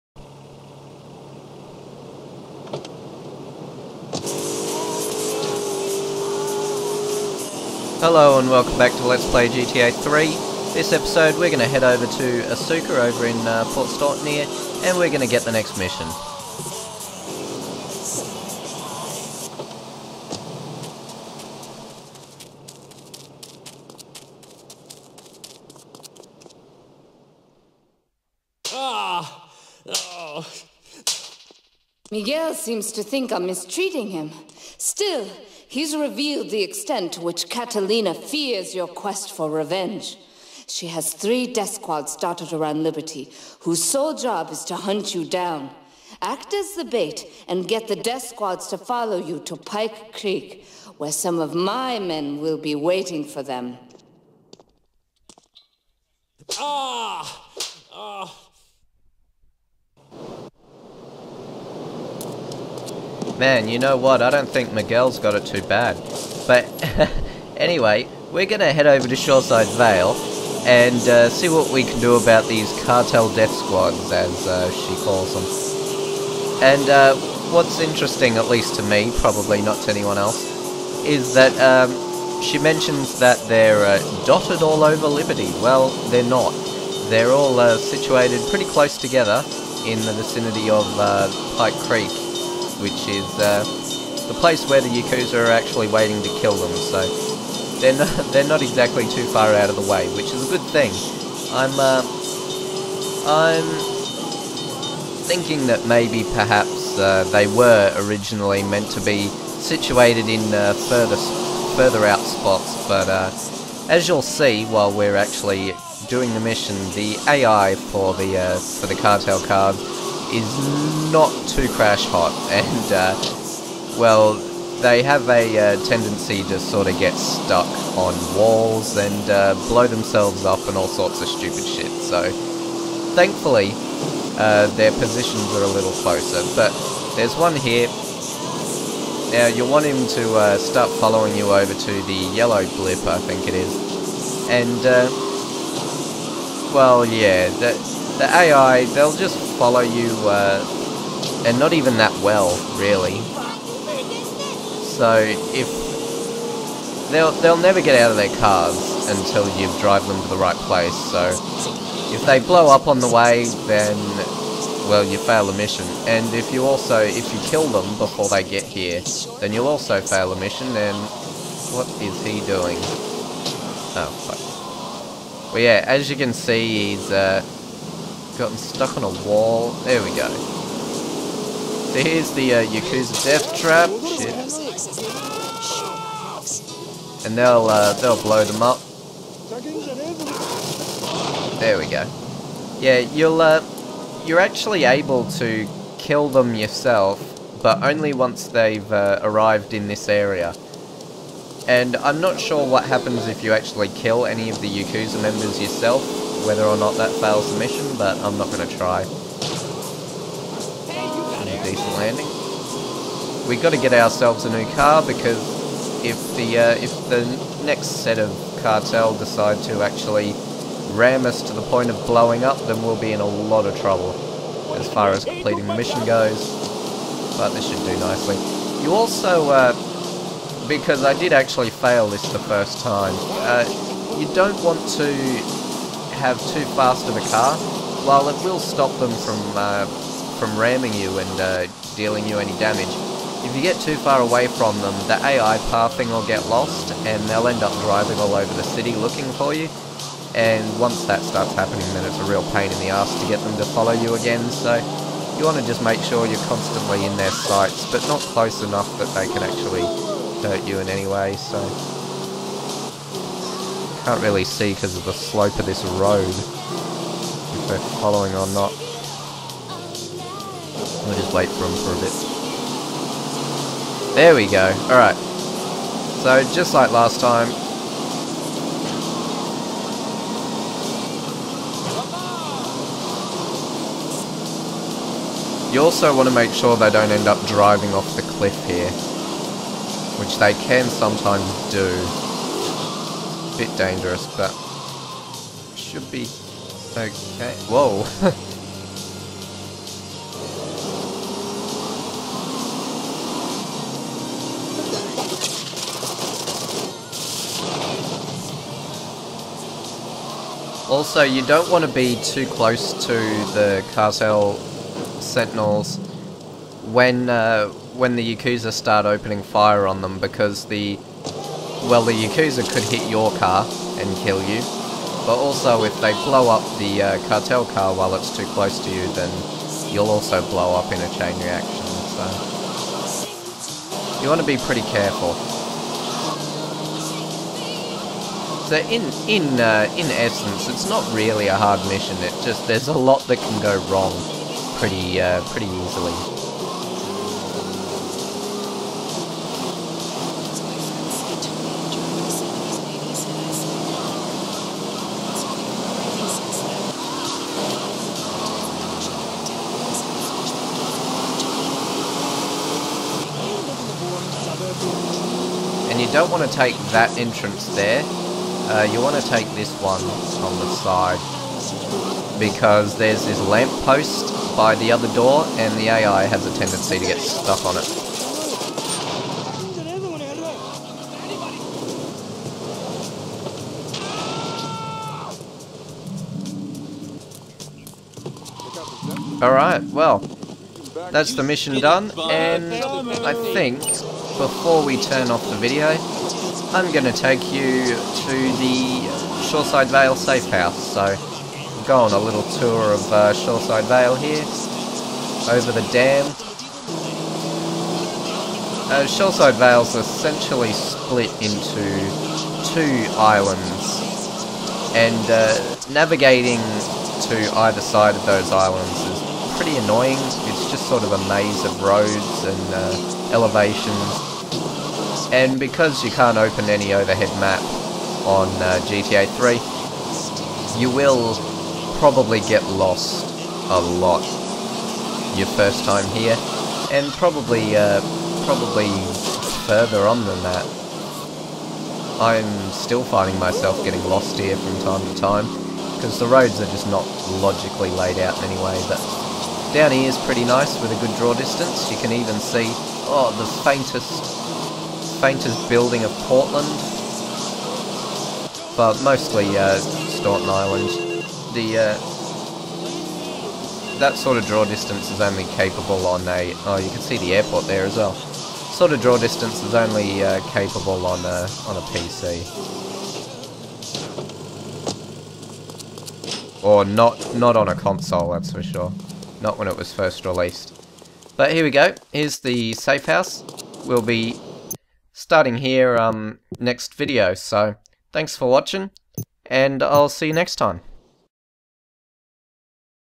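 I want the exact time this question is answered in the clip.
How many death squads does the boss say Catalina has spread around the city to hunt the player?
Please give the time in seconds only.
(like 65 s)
41 s.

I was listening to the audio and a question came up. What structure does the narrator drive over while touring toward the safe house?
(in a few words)
The dam.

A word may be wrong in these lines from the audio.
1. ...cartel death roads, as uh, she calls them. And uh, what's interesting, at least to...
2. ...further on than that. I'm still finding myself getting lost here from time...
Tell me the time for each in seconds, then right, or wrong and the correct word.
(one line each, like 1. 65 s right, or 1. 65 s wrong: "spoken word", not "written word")
1. 72 s wrong: "squads", not "roads"
2. 439 s right.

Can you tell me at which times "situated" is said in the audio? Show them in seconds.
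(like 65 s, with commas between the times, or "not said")
87 s, 109 s.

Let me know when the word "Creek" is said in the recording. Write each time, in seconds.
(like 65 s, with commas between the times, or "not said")
50 s, 91 s.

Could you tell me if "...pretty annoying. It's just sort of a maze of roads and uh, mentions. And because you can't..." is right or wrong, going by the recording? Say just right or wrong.
wrong.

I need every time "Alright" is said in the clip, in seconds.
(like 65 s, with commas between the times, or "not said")
274 s, 389 s.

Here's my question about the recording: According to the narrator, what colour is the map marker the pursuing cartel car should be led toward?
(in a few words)
Yellow.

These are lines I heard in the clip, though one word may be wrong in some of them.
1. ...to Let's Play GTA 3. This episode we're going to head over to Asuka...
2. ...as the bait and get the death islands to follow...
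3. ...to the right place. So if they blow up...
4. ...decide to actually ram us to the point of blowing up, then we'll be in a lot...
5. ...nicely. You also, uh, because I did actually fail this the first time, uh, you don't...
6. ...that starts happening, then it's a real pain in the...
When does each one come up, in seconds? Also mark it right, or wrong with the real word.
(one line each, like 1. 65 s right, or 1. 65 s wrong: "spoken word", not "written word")
1. 8 s right
2. 46 s wrong: "squads", not "islands"
3. 160 s right
4. 219 s right
5. 227 s right
6. 251 s right.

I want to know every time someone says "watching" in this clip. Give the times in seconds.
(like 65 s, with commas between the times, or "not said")
488 s.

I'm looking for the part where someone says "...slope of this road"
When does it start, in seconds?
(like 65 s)
265 s.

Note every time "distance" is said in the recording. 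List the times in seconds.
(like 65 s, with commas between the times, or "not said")
451 s, 464 s, 469 s.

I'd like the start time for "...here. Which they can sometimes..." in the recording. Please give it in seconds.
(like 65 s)
288 s.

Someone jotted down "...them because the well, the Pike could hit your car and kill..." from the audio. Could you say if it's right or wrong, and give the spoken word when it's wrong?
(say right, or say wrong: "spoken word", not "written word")
wrong: "Yakuza", not "Pike".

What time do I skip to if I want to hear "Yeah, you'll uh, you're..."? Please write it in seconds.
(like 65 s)
192 s.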